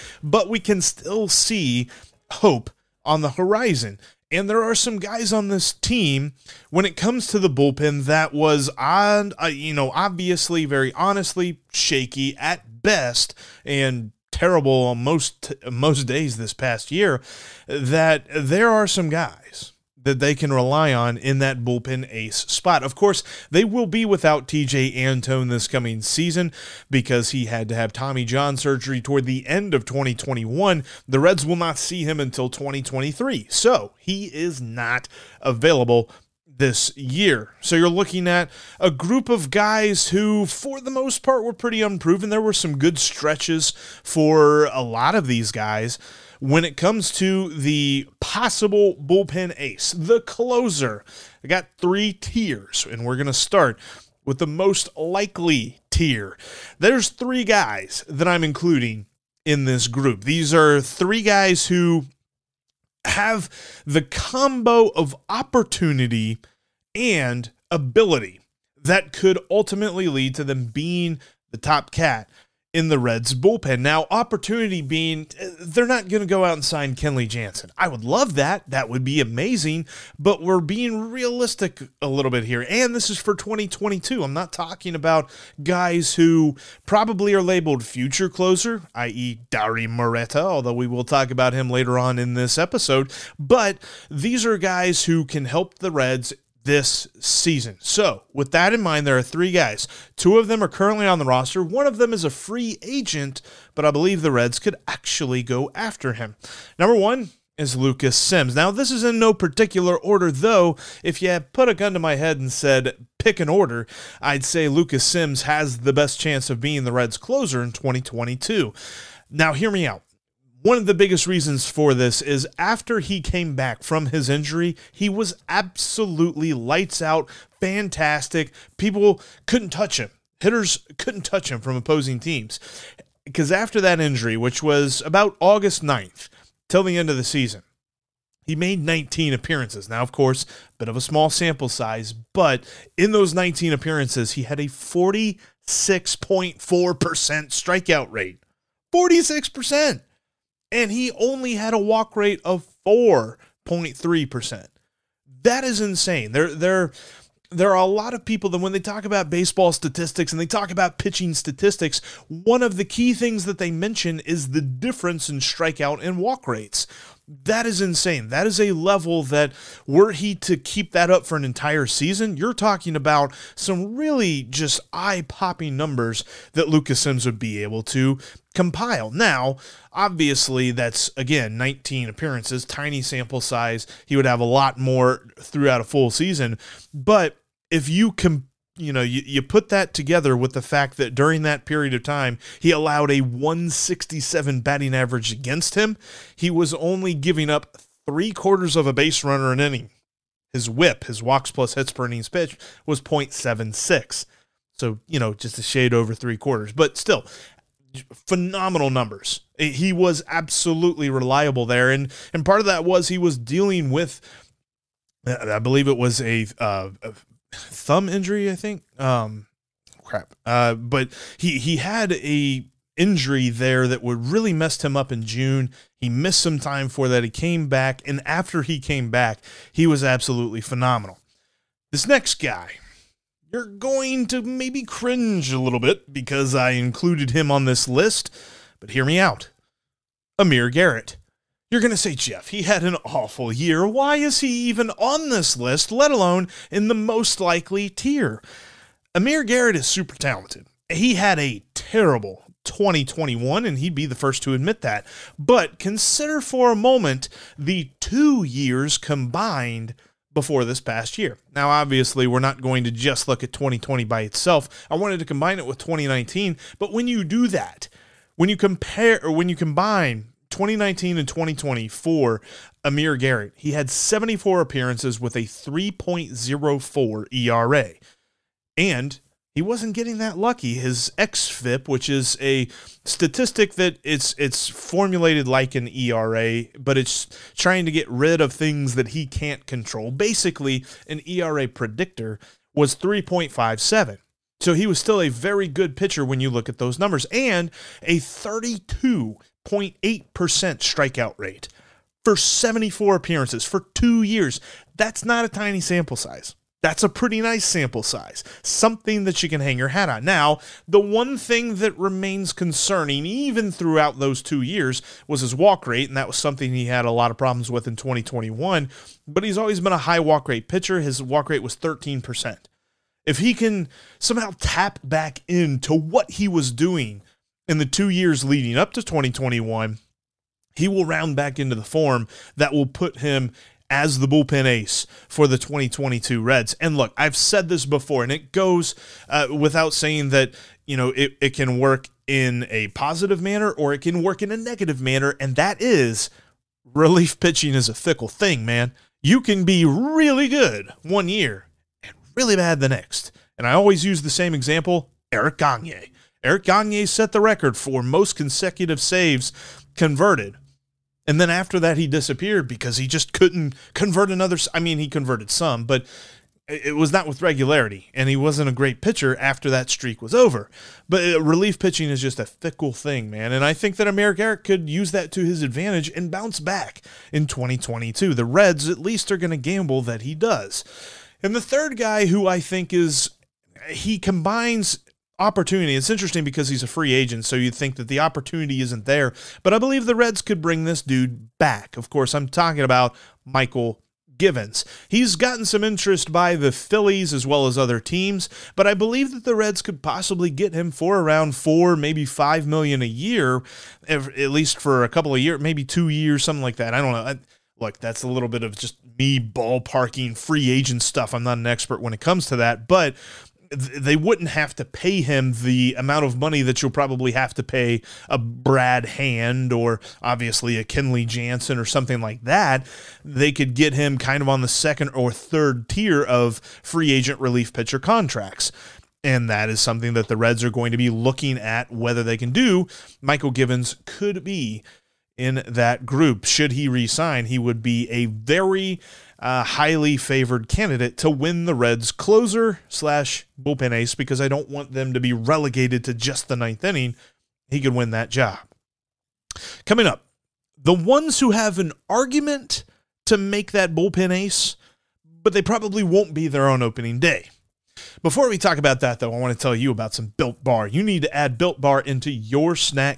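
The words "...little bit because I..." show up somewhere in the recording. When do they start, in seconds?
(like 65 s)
235 s.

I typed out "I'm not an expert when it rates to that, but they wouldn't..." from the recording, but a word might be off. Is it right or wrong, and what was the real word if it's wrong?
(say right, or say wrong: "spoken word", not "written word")
wrong: "comes", not "rates".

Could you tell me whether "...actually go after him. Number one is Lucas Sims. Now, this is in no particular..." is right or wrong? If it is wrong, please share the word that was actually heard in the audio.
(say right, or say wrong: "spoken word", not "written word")
right.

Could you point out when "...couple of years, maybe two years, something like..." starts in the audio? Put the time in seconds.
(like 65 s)
405 s.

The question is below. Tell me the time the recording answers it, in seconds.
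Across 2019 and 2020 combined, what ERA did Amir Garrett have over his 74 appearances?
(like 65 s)
275 s.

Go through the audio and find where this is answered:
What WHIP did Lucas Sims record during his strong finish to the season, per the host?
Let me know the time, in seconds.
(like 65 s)
203 s.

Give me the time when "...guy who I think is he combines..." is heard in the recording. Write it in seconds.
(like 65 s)
381 s.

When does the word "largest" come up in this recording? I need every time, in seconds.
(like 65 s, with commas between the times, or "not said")
not said.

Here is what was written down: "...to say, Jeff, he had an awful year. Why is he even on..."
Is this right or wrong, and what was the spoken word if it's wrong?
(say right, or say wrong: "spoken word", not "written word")
right.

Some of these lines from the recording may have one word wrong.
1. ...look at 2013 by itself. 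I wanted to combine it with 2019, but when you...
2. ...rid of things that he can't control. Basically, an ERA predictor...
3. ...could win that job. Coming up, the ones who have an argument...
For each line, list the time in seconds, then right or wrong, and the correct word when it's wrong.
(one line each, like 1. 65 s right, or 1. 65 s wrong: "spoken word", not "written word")
1. 263 s wrong: "2020", not "2013"
2. 288 s right
3. 447 s right.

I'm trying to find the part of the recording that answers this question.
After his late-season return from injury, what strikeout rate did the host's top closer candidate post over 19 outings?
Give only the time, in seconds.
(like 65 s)
144 s.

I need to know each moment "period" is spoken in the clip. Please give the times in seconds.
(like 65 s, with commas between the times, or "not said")
191 s.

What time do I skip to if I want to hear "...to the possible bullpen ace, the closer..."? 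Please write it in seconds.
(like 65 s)
47 s.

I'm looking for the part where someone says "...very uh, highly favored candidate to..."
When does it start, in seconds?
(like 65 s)
438 s.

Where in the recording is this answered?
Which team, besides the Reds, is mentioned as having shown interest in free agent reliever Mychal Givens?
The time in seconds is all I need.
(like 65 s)
396 s.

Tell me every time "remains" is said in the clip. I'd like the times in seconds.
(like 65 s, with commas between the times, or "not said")
311 s.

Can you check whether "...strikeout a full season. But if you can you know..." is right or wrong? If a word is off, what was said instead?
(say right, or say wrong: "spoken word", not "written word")
wrong: "throughout", not "strikeout".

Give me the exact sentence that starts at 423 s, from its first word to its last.
They could get him kind of on the second or third tier of free agent relief pitcher contracts.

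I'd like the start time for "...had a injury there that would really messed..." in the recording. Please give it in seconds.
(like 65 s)
221 s.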